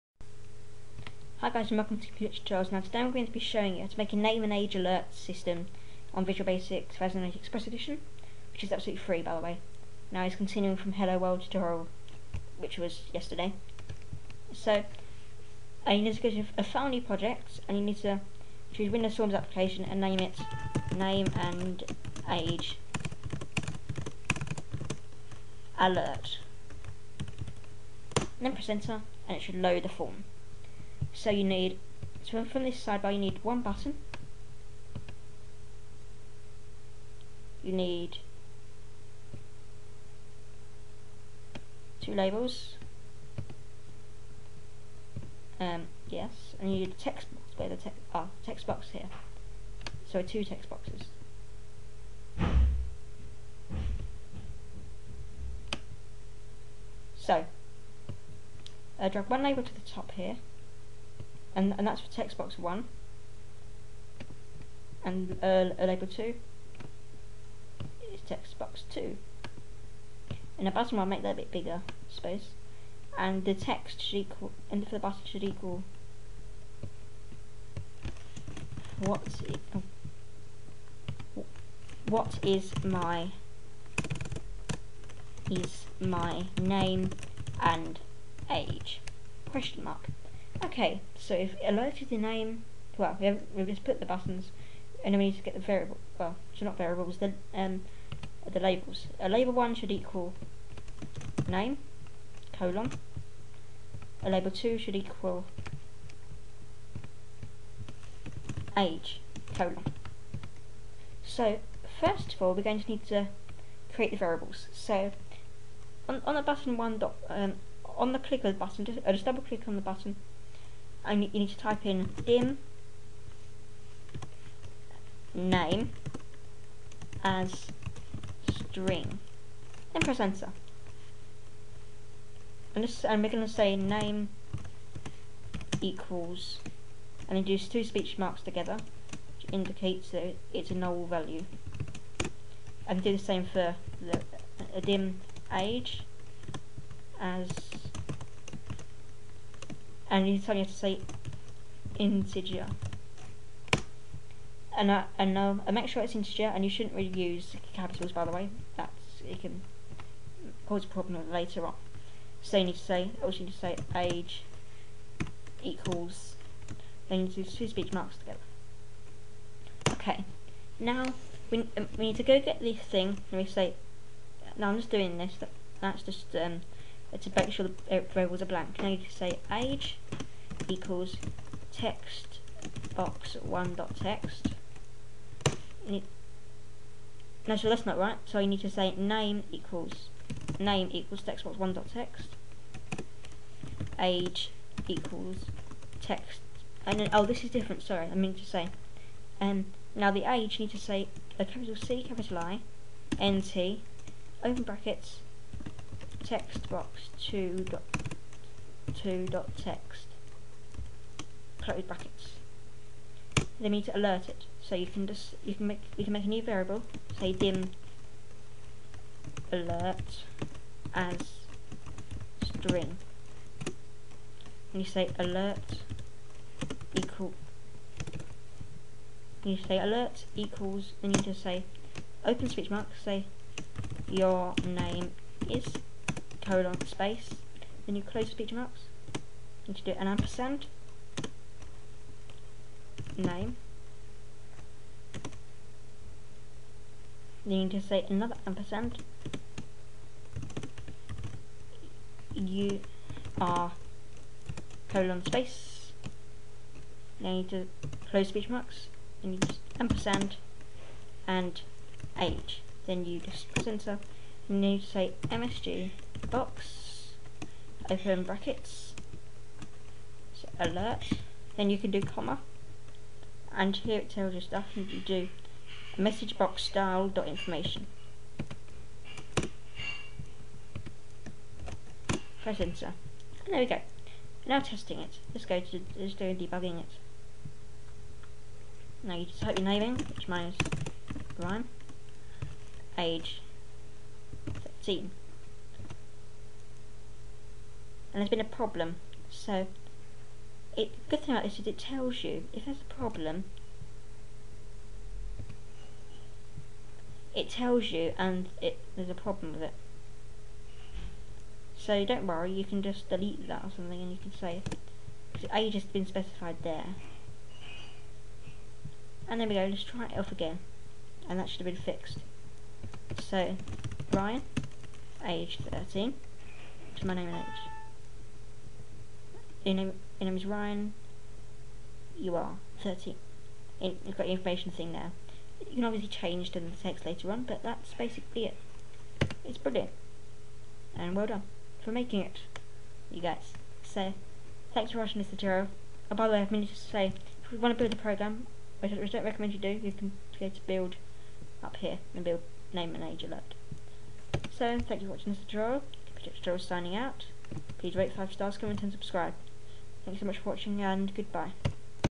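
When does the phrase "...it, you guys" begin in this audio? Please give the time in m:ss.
5:42.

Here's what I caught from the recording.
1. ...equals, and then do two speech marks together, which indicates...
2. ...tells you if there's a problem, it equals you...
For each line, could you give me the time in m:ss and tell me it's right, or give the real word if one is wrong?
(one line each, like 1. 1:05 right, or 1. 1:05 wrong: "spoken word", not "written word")
1. 2:15 right
2. 5:01 wrong: "tells", not "equals".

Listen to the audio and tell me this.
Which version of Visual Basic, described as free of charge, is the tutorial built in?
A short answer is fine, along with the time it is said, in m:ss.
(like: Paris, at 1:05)
2008 Express Edition, at 0:06.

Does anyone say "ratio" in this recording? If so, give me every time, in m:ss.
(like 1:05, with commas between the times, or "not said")
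not said.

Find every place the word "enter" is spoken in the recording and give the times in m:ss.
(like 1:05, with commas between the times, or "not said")
0:28, 2:10, 4:23, 4:42.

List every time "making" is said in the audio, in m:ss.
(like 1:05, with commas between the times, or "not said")
5:41.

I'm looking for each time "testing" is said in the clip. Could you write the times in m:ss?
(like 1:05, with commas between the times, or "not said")
4:44.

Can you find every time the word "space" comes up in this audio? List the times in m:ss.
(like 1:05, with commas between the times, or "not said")
3:56, 4:15.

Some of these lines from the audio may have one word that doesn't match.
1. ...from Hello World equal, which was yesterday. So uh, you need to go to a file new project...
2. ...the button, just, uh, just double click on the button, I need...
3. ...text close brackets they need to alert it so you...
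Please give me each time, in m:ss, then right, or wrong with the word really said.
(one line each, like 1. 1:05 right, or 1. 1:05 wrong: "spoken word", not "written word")
1. 0:10 wrong: "tutorial", not "equal"
2. 1:58 right
3. 3:29 right.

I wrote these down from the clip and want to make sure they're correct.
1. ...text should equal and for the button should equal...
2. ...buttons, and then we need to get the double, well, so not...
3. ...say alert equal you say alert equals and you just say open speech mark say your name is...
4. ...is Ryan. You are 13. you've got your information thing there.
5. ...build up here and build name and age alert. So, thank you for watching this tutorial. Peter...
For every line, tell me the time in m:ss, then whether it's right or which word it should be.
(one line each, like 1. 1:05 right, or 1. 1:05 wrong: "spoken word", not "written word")
1. 1:13 right
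2. 1:34 wrong: "variable", not "double"
3. 3:44 right
4. 5:30 right
5. 5:50 right.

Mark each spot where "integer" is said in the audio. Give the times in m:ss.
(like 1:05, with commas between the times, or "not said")
2:31, 2:36.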